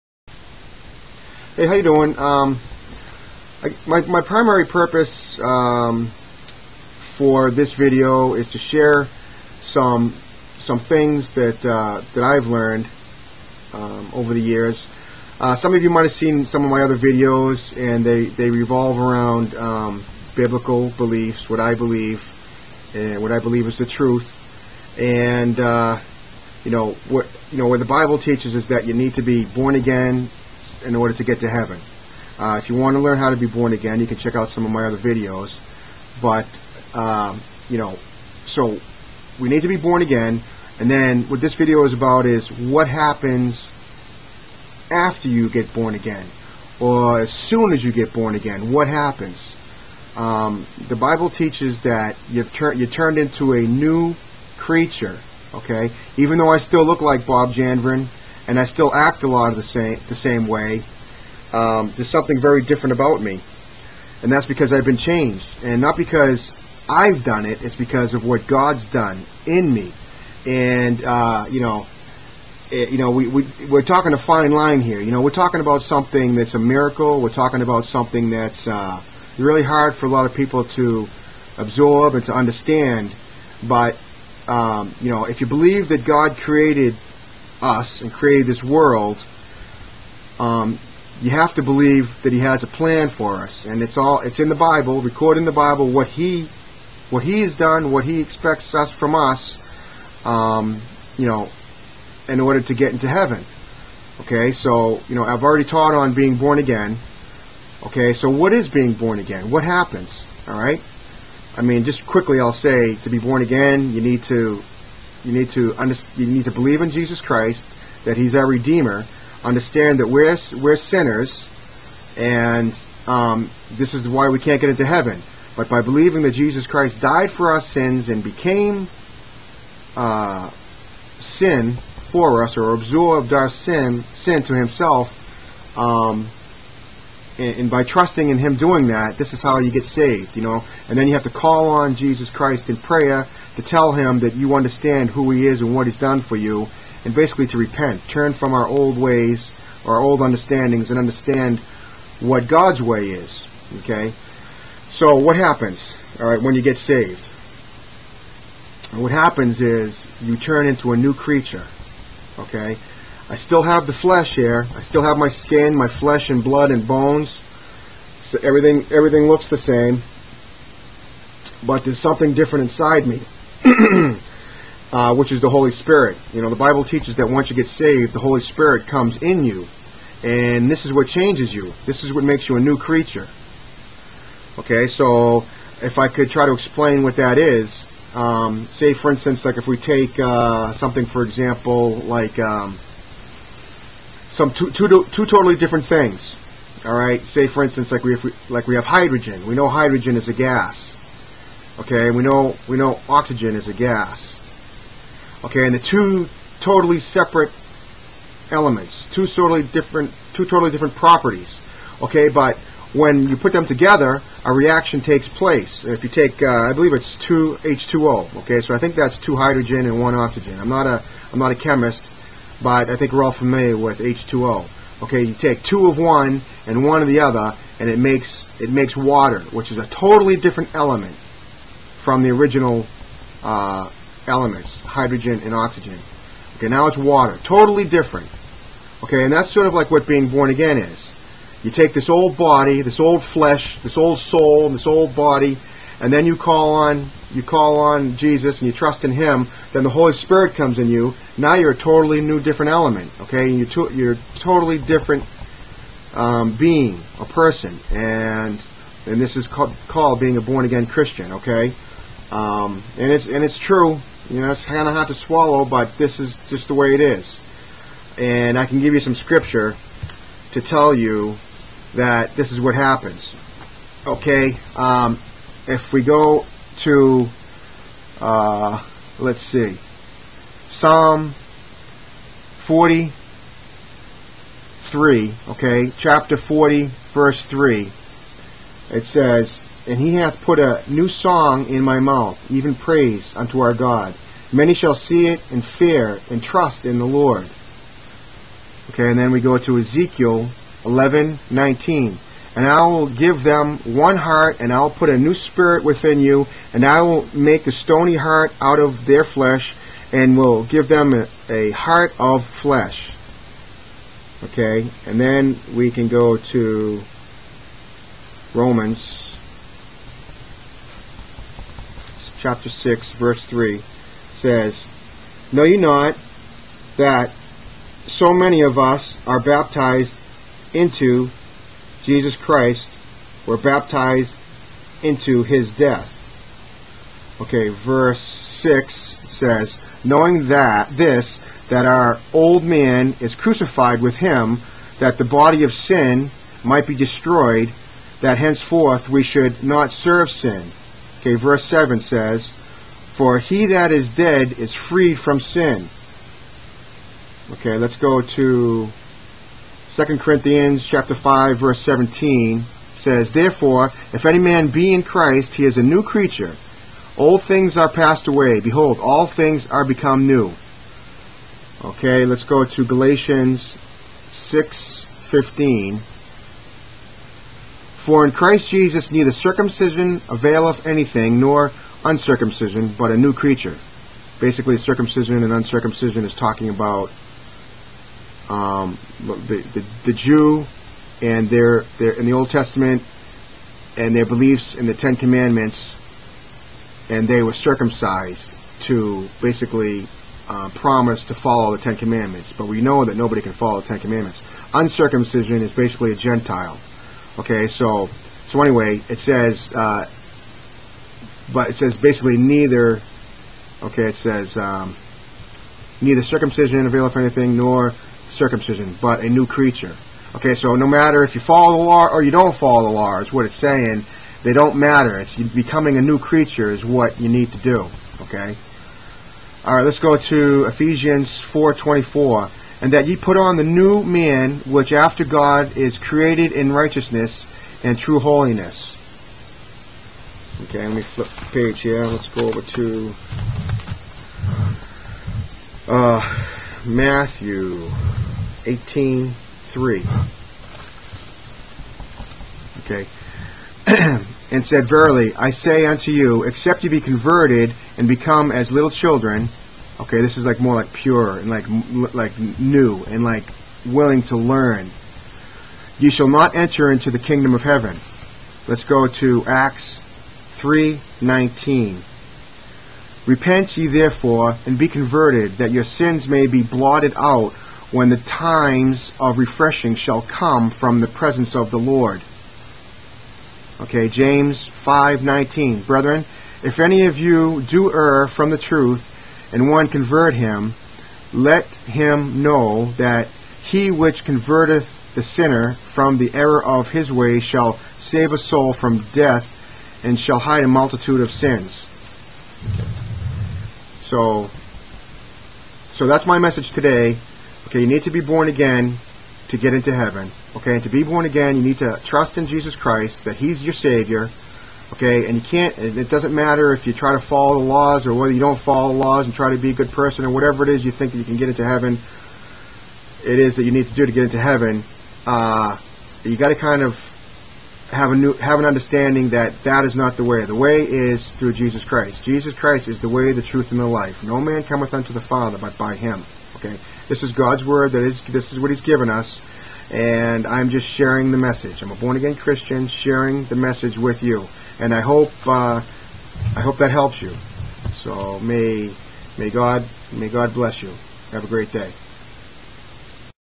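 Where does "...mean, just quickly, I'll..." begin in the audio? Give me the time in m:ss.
1:51.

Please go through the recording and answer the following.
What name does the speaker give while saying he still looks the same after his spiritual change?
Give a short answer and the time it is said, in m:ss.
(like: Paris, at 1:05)
Bob Janvrin, at 0:57.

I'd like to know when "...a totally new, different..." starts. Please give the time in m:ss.
4:11.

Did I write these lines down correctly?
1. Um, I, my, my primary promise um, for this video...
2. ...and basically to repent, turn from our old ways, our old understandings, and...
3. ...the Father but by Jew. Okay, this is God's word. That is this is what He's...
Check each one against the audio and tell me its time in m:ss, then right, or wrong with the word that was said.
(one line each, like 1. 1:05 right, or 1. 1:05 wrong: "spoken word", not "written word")
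1. 0:02 wrong: "purpose", not "promise"
2. 2:27 right
3. 8:55 wrong: "Him", not "Jew".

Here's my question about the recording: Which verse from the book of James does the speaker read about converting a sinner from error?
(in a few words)
James 5:19.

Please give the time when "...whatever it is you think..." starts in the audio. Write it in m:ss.
8:40.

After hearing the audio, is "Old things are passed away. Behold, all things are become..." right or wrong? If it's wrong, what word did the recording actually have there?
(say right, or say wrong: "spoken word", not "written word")
right.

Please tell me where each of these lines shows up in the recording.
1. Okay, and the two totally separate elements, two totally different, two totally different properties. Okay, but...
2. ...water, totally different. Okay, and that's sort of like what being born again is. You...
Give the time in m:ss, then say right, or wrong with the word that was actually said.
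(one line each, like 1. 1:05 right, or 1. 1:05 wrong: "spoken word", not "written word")
1. 3:25 right
2. 3:56 right.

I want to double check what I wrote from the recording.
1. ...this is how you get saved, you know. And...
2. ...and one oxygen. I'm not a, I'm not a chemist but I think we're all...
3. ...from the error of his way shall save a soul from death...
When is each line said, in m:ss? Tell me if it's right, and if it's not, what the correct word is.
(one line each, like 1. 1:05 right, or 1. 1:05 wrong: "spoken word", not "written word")
1. 2:19 right
2. 3:39 right
3. 8:15 right.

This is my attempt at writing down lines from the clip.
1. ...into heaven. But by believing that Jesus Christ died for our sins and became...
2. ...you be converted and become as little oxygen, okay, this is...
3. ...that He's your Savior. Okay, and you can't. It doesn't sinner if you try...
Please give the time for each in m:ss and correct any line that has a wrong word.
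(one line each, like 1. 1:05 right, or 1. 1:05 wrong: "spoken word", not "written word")
1. 2:04 right
2. 7:36 wrong: "children", not "oxygen"
3. 8:33 wrong: "matter", not "sinner".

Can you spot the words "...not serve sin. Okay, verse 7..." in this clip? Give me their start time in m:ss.
5:49.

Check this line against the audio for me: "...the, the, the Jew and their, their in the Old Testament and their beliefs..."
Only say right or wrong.
right.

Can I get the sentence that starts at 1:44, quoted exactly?
Okay, so you know I've already taught on being born again.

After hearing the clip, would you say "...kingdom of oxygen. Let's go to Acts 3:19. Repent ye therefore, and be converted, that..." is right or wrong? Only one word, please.
wrong.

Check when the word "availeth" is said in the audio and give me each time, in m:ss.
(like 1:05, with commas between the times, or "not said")
6:20, 6:56.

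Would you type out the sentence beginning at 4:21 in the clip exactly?
Okay, um, and it's and it's true.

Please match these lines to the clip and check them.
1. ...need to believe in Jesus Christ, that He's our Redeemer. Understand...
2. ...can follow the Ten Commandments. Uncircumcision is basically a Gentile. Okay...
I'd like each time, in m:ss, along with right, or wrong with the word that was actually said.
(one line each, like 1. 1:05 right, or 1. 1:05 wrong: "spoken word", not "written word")
1. 1:56 right
2. 6:43 right.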